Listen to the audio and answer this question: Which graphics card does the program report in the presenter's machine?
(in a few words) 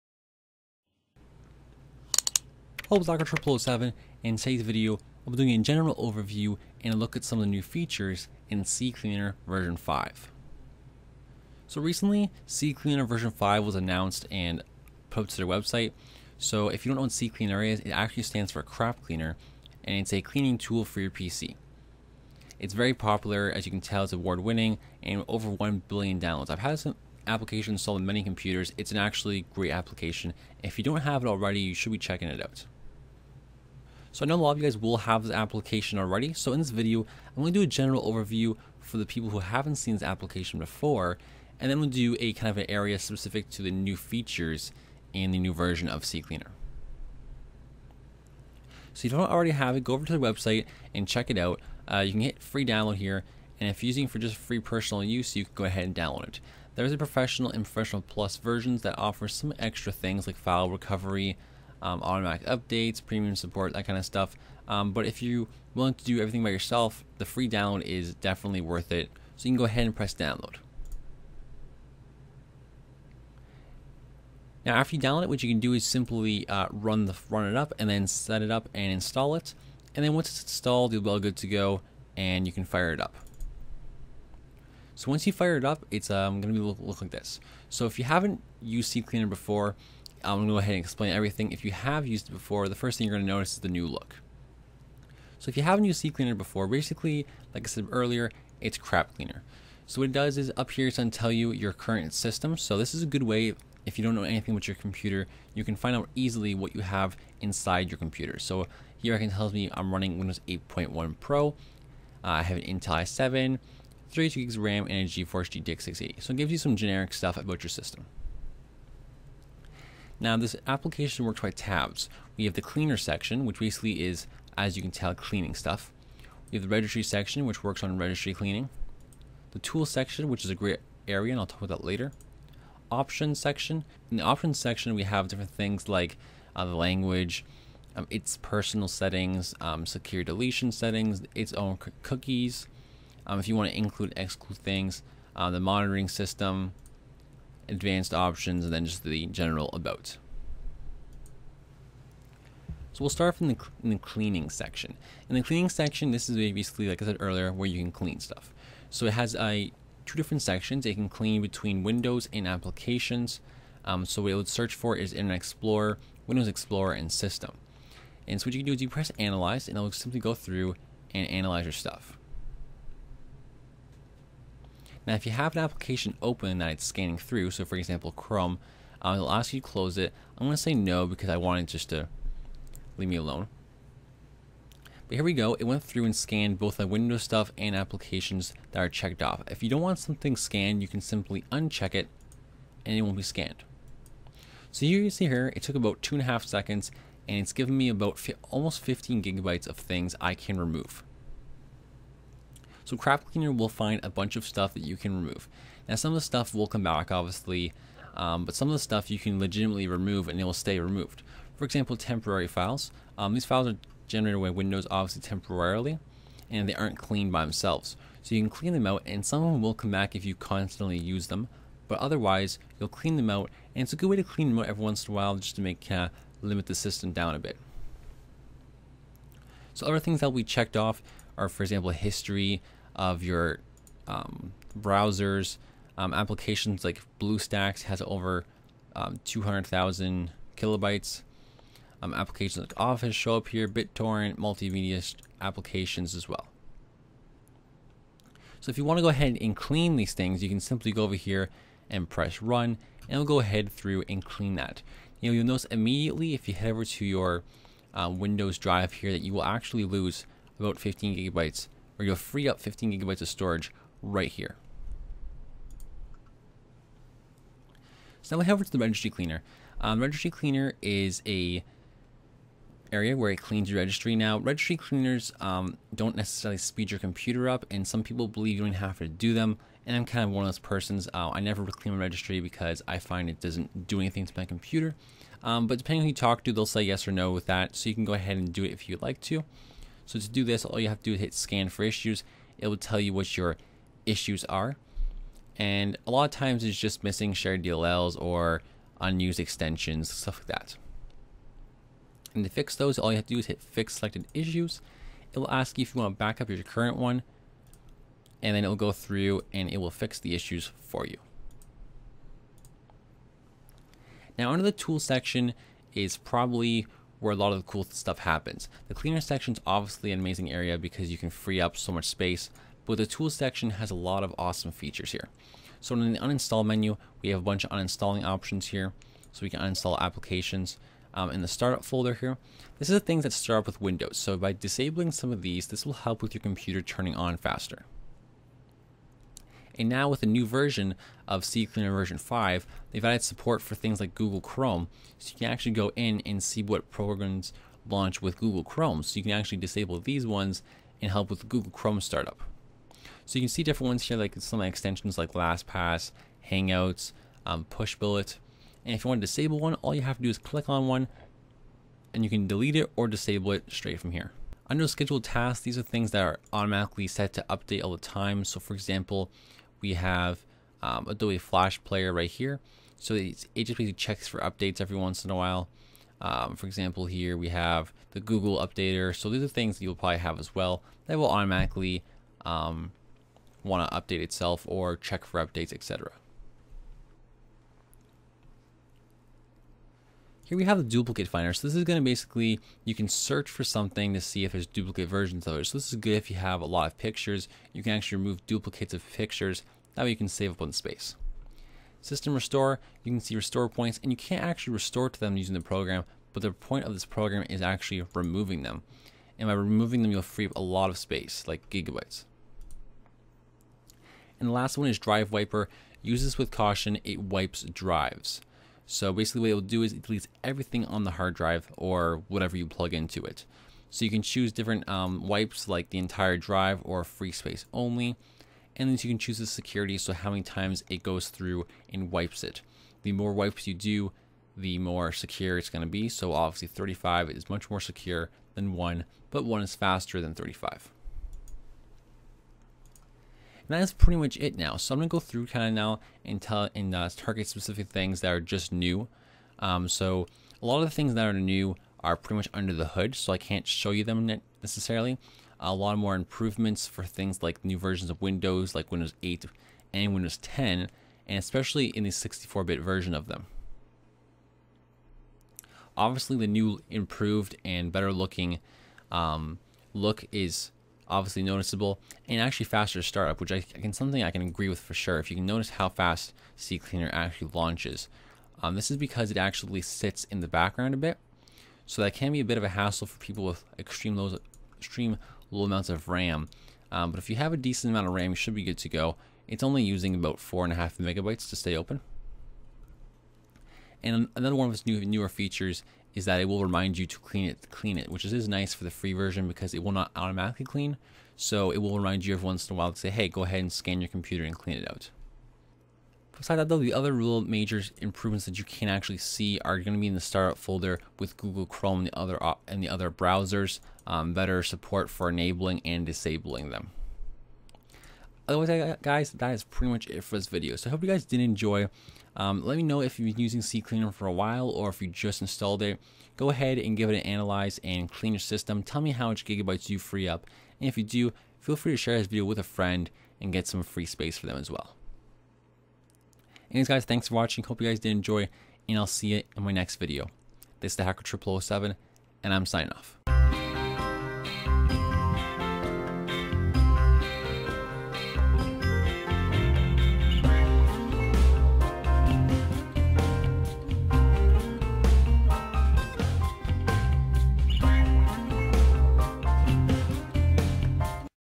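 GeForce GTX 680.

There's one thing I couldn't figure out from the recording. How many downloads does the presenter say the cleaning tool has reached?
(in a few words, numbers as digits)
over 1 billion.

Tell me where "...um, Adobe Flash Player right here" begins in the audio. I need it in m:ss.
6:10.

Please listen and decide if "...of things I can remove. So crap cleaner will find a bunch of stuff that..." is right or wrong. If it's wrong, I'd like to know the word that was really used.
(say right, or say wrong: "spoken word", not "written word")
right.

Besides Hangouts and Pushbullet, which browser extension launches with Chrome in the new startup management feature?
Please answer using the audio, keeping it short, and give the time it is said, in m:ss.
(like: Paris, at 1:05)
LastPass, at 5:55.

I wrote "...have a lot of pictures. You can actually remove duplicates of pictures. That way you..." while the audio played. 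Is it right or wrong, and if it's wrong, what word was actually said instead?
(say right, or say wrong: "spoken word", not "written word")
right.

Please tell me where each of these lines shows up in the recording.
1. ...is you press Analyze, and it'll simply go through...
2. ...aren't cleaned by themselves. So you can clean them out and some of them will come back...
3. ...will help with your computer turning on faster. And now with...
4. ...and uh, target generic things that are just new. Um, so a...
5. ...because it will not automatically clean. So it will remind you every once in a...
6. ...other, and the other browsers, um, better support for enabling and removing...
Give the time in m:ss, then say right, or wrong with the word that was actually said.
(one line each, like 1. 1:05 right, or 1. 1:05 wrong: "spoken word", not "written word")
1. 2:48 right
2. 3:36 right
3. 5:35 right
4. 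7:26 wrong: "specific", not "generic"
5. 8:19 right
6. 8:32 wrong: "disabling", not "removing".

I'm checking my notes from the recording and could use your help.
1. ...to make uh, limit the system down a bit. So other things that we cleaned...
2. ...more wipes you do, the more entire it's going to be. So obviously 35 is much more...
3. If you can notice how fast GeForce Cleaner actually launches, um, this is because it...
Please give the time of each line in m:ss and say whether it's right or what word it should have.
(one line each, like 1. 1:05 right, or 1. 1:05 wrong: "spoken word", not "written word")
1. 3:45 wrong: "checked", not "cleaned"
2. 7:13 wrong: "secure", not "entire"
3. 7:55 wrong: "CCleaner", not "GeForce".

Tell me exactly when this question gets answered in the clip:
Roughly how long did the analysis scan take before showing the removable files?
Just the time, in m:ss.
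3:16.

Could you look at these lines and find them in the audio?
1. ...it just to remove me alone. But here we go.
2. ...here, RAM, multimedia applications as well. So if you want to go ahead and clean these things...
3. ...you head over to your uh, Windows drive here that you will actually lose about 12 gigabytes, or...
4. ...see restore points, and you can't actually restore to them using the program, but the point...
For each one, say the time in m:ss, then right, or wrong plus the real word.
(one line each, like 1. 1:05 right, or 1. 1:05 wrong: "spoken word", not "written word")
1. 3:01 wrong: "leave", not "remove"
2. 4:03 wrong: "BitTorrent", not "RAM"
3. 4:16 wrong: "15", not "12"
4. 6:43 right.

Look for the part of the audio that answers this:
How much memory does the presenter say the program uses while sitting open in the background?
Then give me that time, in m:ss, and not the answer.
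8:10.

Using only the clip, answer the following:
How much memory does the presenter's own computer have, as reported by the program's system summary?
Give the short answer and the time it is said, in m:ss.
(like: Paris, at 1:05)
32 gigs, at 1:54.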